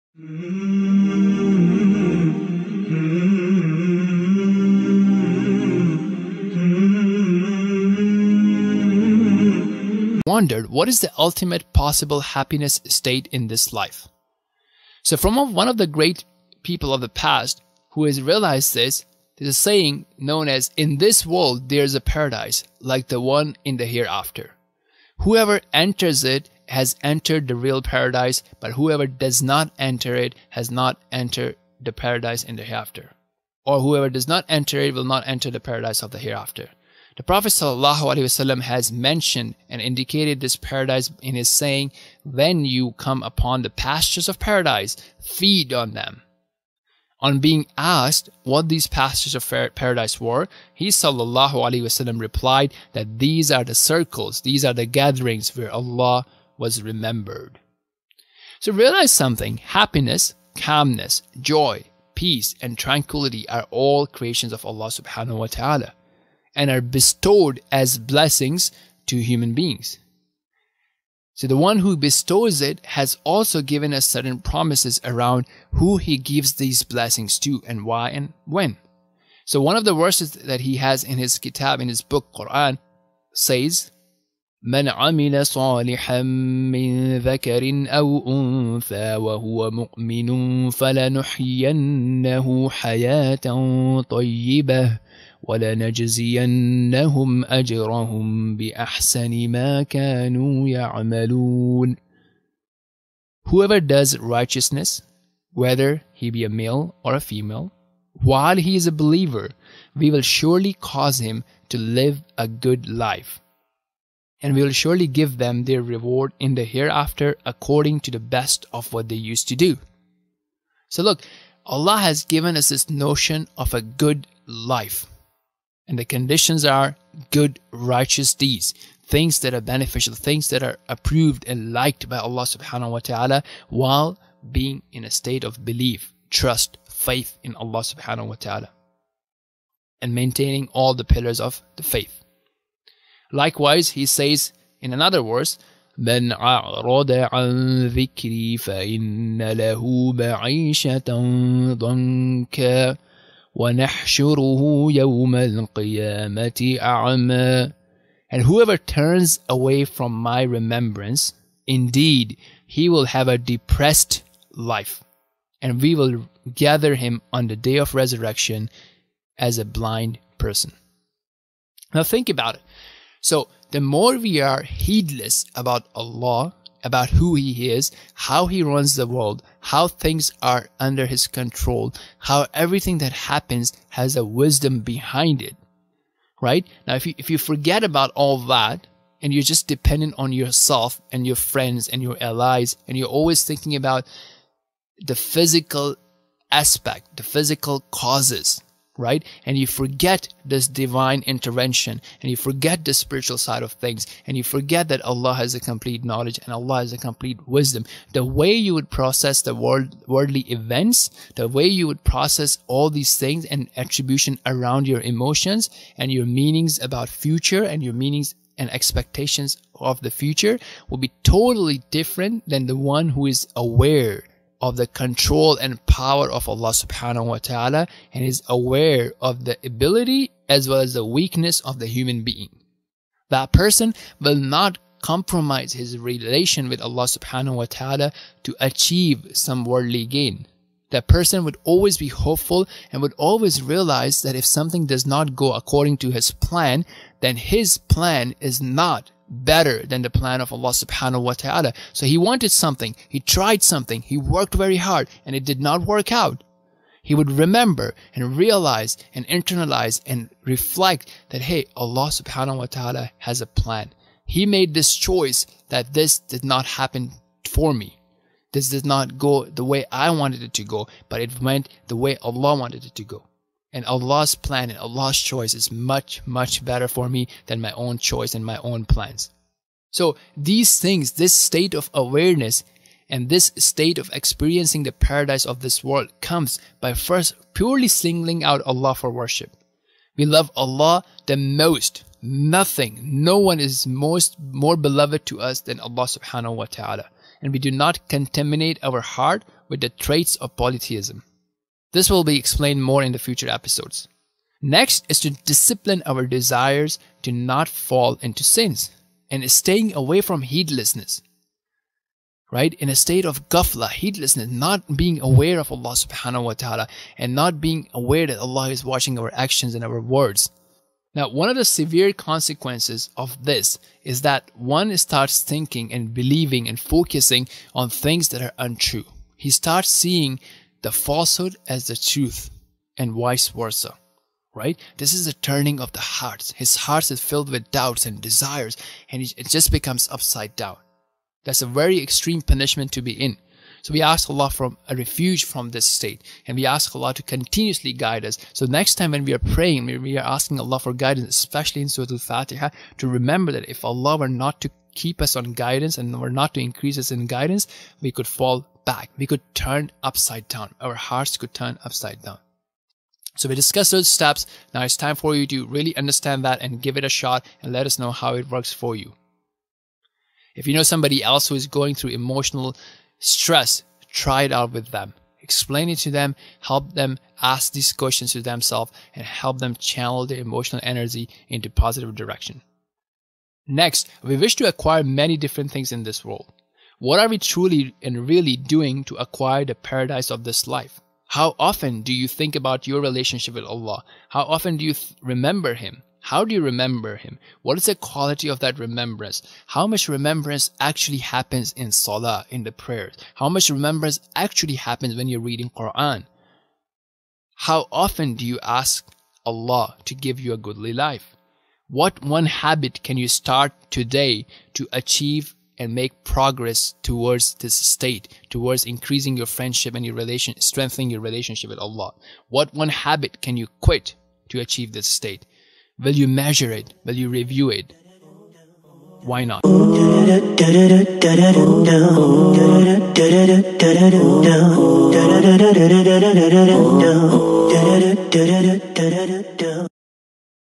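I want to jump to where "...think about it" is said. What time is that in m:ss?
2:52.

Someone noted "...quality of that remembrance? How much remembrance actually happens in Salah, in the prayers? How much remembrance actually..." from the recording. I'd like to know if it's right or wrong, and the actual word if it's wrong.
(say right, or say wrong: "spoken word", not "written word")
right.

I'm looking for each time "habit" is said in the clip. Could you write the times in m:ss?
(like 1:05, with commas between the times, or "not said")
6:52, 7:02.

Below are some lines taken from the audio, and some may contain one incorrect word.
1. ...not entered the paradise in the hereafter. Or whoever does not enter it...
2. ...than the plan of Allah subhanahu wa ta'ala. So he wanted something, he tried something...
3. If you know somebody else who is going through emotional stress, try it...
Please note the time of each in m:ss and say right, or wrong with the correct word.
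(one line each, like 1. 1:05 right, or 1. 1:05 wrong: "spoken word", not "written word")
1. 0:30 right
2. 4:09 right
3. 6:10 right.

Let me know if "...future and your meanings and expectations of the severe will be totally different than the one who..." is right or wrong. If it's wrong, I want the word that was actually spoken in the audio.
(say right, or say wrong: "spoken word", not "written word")
wrong: "future", not "severe".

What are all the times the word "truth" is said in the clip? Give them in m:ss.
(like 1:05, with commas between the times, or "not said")
5:31.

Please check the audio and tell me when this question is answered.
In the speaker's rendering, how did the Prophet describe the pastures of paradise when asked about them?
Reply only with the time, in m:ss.
0:54.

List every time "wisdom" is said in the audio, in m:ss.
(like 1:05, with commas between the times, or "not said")
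3:04, 3:27.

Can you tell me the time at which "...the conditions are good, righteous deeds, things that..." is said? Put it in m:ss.
2:05.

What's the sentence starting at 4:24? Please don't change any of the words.
He made this choice that this did not happen for me.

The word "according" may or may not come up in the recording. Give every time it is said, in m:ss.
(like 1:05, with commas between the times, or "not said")
1:57, 4:05.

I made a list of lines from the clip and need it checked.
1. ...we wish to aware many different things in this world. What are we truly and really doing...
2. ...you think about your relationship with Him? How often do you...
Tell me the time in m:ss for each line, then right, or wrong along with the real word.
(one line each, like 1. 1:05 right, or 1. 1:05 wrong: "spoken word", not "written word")
1. 6:24 wrong: "acquire", not "aware"
2. 6:32 wrong: "Allah", not "Him".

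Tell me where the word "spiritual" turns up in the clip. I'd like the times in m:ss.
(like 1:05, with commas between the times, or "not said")
3:22.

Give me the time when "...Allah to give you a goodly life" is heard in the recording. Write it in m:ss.
6:49.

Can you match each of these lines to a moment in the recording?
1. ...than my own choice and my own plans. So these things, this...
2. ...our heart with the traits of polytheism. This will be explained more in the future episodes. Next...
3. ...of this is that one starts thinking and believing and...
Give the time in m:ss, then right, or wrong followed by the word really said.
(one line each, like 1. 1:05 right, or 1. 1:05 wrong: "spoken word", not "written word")
1. 4:37 right
2. 4:58 right
3. 5:23 right.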